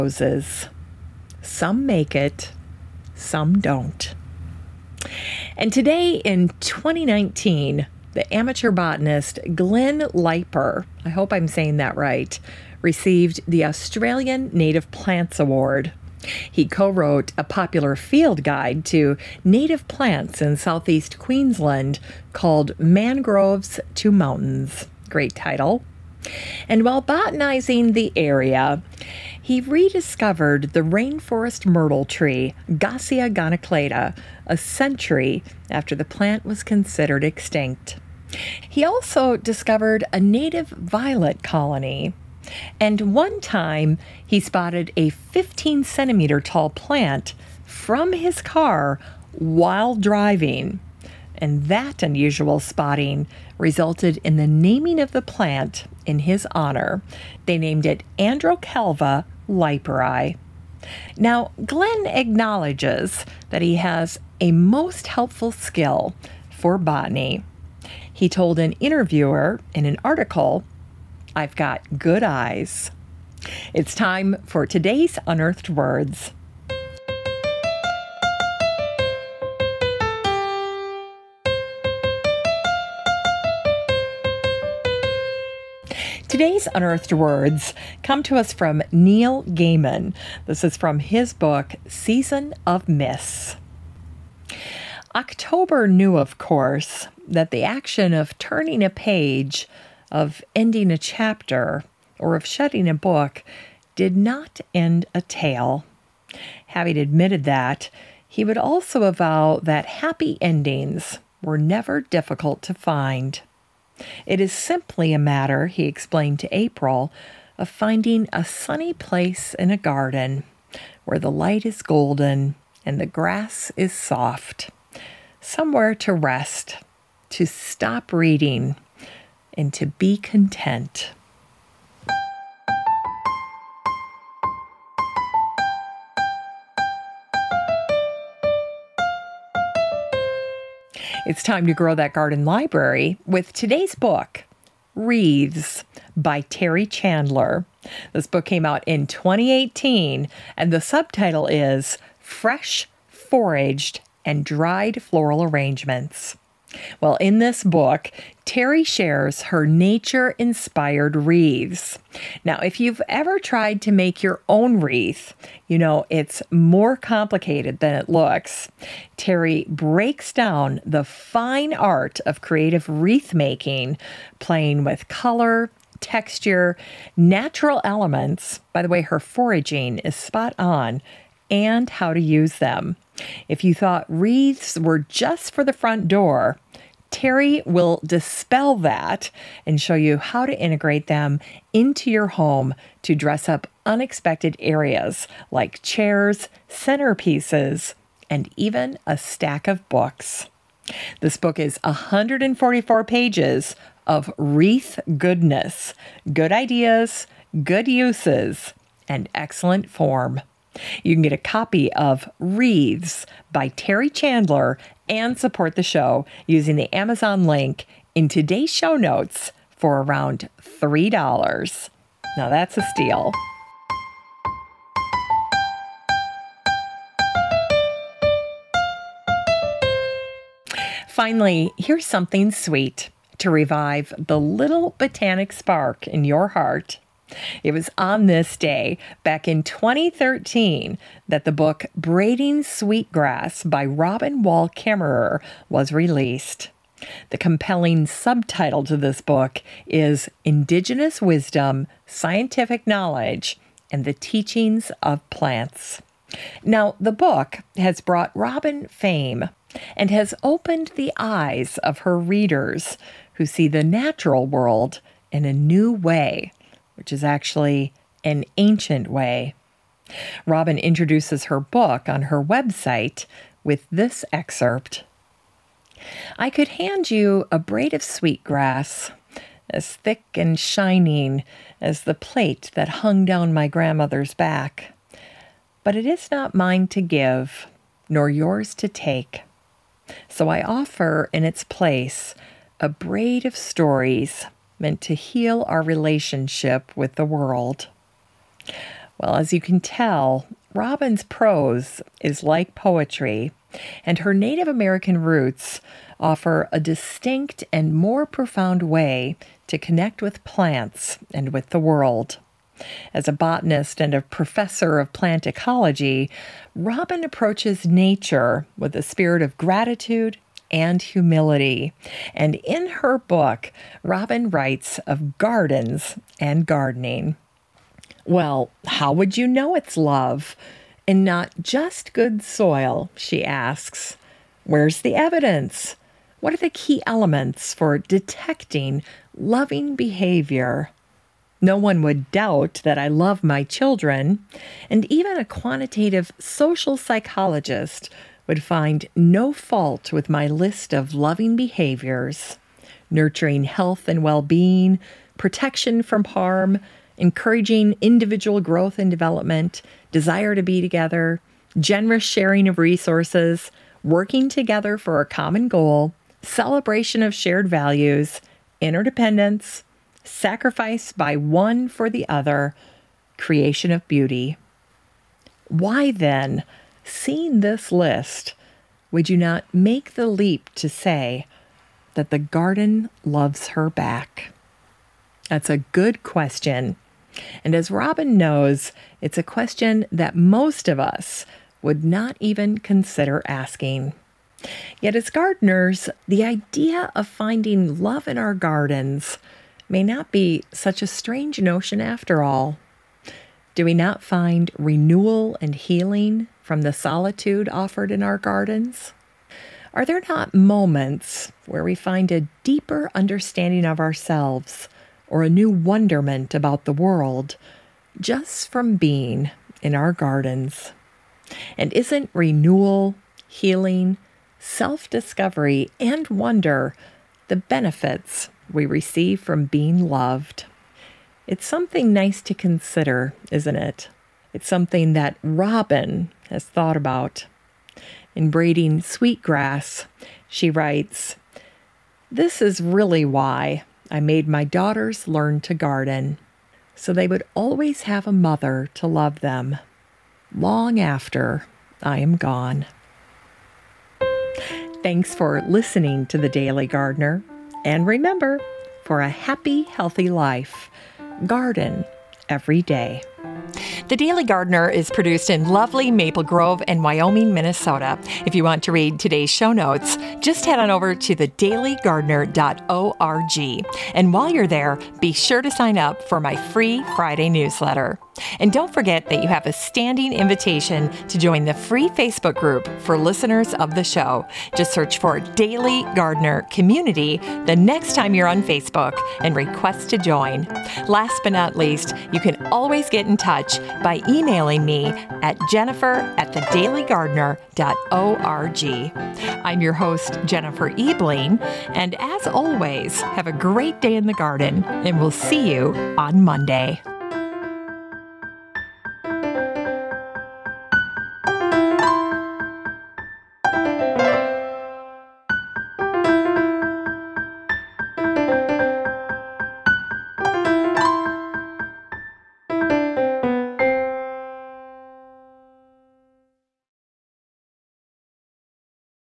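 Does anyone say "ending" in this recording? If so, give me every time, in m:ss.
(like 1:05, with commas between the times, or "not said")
1:40, 1:50.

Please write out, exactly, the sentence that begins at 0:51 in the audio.
And that unusual spotting resulted in the naming of the plant in his honor.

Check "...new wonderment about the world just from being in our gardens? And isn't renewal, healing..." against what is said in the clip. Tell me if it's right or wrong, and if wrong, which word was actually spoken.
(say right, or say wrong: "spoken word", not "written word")
right.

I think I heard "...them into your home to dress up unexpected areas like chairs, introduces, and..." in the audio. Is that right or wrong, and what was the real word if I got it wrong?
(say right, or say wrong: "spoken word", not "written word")
wrong: "centerpieces", not "introduces".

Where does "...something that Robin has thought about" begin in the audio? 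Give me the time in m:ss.
7:14.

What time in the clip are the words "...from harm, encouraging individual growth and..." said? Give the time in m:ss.
5:56.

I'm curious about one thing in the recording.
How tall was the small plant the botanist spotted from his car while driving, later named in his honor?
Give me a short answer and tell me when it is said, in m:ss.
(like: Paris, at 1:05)
15 centimeters, at 0:45.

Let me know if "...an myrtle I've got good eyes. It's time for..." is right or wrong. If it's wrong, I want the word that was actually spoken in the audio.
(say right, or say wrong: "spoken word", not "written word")
wrong: "article", not "myrtle".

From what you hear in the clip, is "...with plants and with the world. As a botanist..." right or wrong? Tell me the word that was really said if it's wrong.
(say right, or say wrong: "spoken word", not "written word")
right.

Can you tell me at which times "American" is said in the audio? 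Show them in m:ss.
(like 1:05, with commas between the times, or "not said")
5:04.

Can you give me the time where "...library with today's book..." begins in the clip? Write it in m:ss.
2:22.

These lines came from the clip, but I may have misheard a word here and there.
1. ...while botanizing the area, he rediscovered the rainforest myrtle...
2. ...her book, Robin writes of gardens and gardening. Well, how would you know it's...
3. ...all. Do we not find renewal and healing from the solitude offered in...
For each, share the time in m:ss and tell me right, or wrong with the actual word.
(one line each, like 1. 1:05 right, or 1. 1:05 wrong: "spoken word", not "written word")
1. 0:26 right
2. 5:22 right
3. 6:42 right.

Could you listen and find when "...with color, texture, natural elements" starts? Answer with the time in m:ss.
2:54.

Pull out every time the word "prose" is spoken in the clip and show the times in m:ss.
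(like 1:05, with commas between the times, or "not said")
5:01.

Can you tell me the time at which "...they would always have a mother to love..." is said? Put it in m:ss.
7:27.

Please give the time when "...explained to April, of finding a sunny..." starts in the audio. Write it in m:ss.
1:55.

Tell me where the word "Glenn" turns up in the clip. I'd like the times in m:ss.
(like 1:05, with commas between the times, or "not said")
0:09, 1:01.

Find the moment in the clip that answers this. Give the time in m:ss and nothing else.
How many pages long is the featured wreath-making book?
3:21.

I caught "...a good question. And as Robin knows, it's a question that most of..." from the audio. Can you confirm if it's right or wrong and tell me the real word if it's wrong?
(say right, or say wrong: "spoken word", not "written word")
right.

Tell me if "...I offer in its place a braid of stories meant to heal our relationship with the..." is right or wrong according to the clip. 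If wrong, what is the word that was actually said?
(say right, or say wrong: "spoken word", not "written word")
right.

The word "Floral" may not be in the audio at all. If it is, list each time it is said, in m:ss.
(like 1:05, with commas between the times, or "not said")
2:35.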